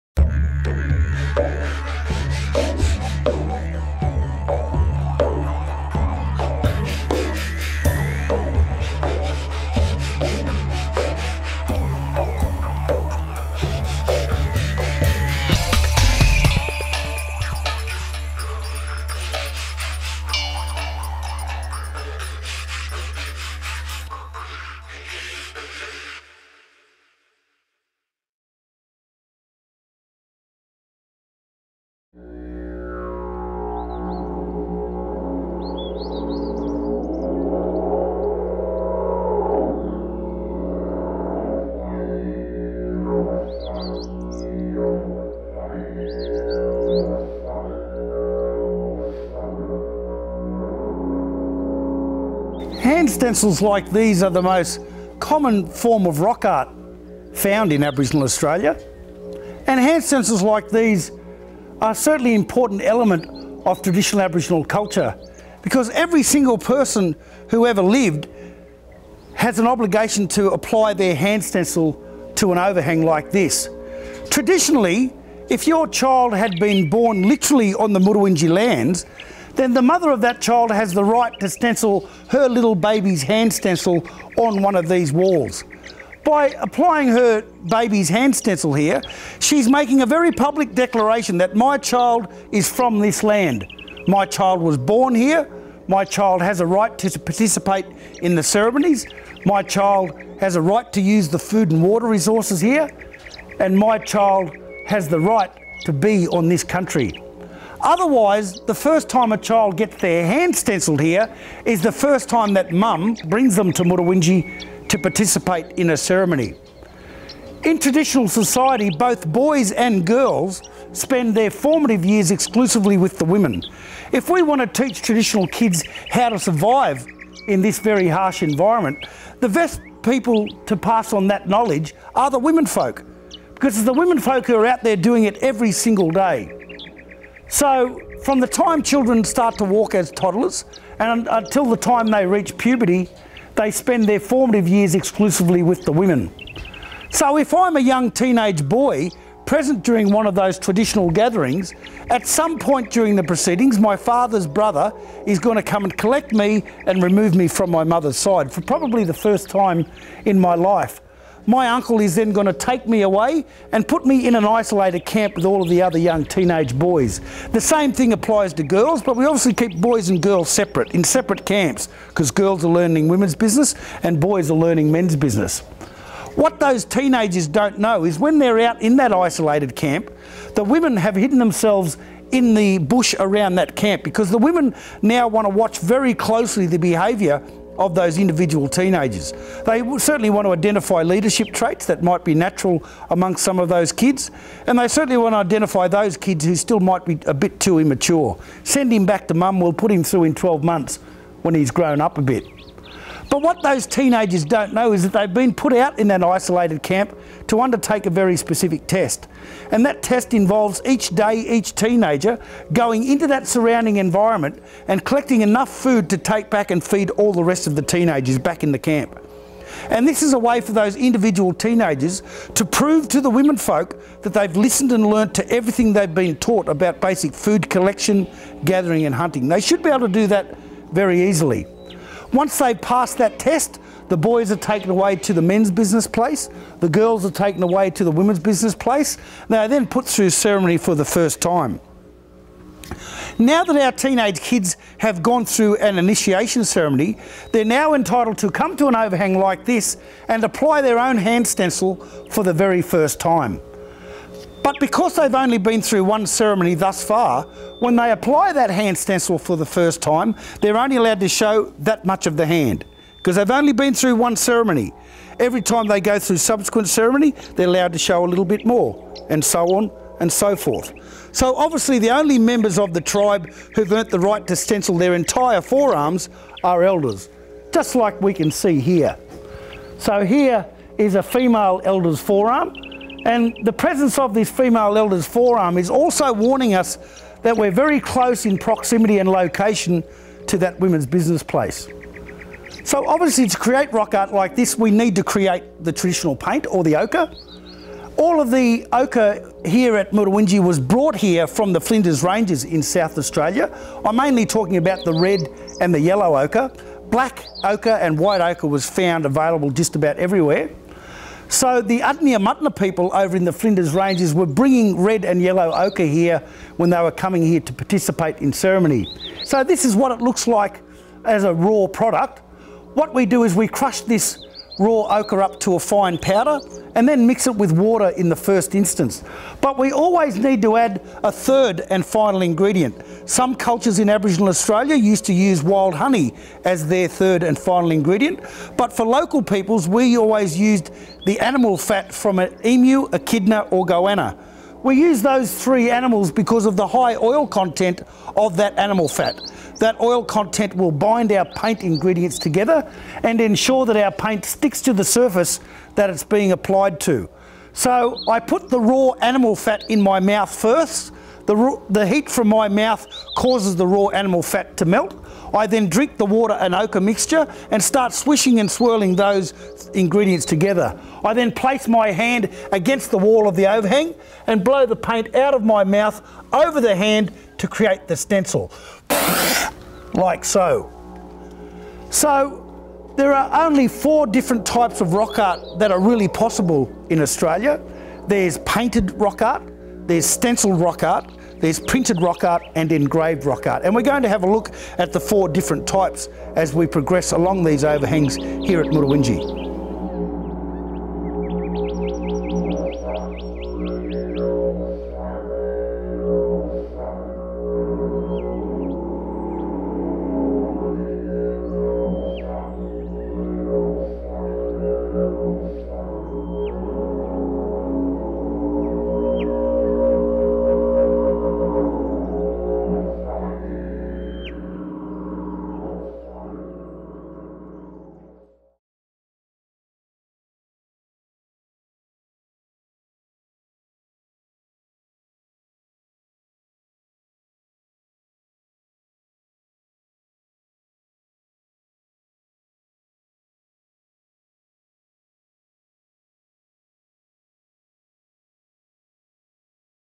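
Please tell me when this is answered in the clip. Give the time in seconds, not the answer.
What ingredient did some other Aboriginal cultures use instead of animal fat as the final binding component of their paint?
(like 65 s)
335 s.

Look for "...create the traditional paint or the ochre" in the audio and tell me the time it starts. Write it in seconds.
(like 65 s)
295 s.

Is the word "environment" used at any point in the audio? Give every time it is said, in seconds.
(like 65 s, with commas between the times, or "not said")
128 s, 213 s.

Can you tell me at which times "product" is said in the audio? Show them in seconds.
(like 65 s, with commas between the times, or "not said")
321 s.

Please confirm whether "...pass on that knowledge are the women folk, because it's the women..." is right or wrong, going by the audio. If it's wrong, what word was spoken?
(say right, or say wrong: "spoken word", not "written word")
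right.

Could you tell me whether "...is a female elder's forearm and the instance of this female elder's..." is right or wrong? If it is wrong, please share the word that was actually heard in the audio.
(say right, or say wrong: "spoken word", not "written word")
wrong: "presence", not "instance".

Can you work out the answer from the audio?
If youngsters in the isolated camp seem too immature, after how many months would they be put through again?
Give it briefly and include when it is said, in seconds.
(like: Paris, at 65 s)
12, at 200 s.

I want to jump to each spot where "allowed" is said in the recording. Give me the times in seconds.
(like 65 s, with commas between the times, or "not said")
260 s, 267 s.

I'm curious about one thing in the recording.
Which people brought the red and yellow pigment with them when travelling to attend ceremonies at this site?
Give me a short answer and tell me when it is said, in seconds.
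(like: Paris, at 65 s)
Adnyamathanha, at 311 s.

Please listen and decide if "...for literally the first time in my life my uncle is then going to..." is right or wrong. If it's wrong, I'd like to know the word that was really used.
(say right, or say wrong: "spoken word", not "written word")
wrong: "probably", not "literally".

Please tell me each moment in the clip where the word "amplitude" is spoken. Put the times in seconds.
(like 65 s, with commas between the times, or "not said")
not said.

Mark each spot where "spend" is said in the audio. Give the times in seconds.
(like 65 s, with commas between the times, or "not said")
120 s, 143 s.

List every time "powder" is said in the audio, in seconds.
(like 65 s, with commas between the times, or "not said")
326 s.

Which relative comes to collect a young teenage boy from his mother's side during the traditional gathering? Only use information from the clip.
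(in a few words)
Father's brother.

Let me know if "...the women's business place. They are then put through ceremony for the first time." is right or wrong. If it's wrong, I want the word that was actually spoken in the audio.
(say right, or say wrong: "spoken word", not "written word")
right.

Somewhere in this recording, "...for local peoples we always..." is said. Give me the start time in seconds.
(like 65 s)
338 s.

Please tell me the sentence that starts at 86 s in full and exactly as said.
By applying her baby's hand stencil here, she's making a very public declaration that my child is from this land.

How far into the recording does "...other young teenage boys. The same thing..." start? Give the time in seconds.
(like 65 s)
165 s.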